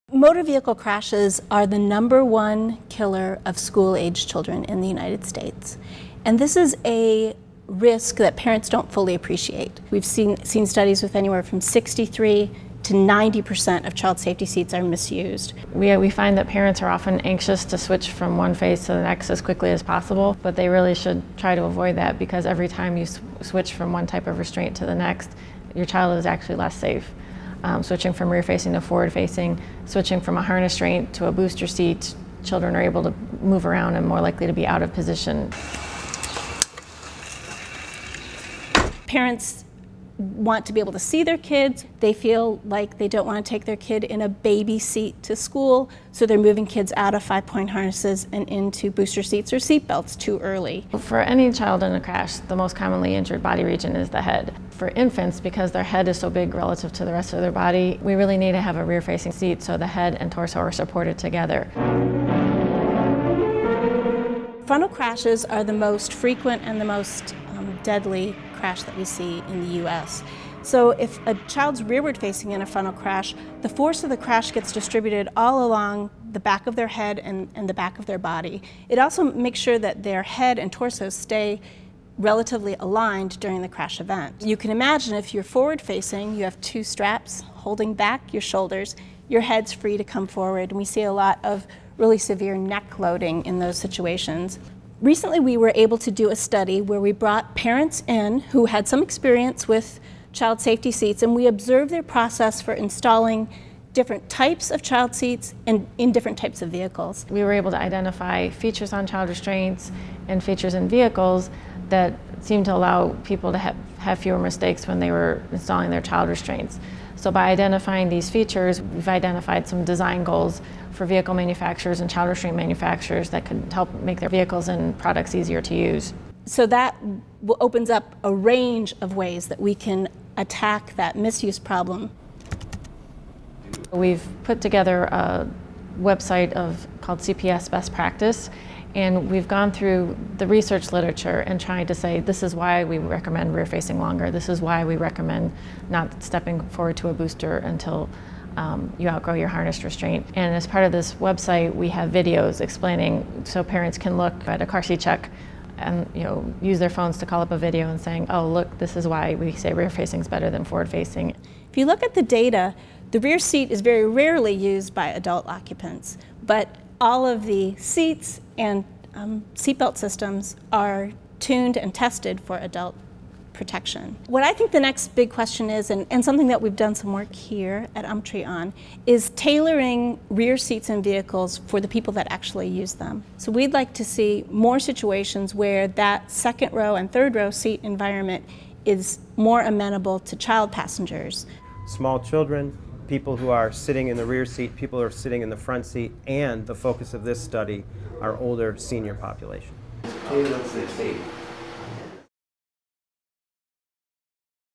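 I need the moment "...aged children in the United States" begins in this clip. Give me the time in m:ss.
0:03.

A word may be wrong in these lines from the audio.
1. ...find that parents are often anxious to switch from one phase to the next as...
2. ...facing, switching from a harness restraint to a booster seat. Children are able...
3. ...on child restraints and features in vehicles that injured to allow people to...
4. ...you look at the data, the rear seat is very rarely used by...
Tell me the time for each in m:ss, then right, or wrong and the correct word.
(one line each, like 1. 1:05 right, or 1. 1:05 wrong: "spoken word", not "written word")
1. 0:16 right
2. 0:29 right
3. 1:48 wrong: "seemed", not "injured"
4. 2:41 right.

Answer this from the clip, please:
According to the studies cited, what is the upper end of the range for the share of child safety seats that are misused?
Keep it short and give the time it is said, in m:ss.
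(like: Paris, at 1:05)
90%, at 0:12.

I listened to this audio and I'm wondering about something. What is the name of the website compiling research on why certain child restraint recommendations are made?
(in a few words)
CPS Best Practice.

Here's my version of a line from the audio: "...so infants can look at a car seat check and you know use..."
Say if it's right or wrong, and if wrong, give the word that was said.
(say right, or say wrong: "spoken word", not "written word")
wrong: "parents", not "infants".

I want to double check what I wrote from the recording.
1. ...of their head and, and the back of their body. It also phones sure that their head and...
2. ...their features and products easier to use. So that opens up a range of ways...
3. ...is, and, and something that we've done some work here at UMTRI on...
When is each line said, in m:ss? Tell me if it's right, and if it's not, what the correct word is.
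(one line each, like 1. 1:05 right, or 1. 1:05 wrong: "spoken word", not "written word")
1. 1:16 wrong: "makes", not "phones"
2. 2:04 wrong: "vehicles", not "features"
3. 2:55 right.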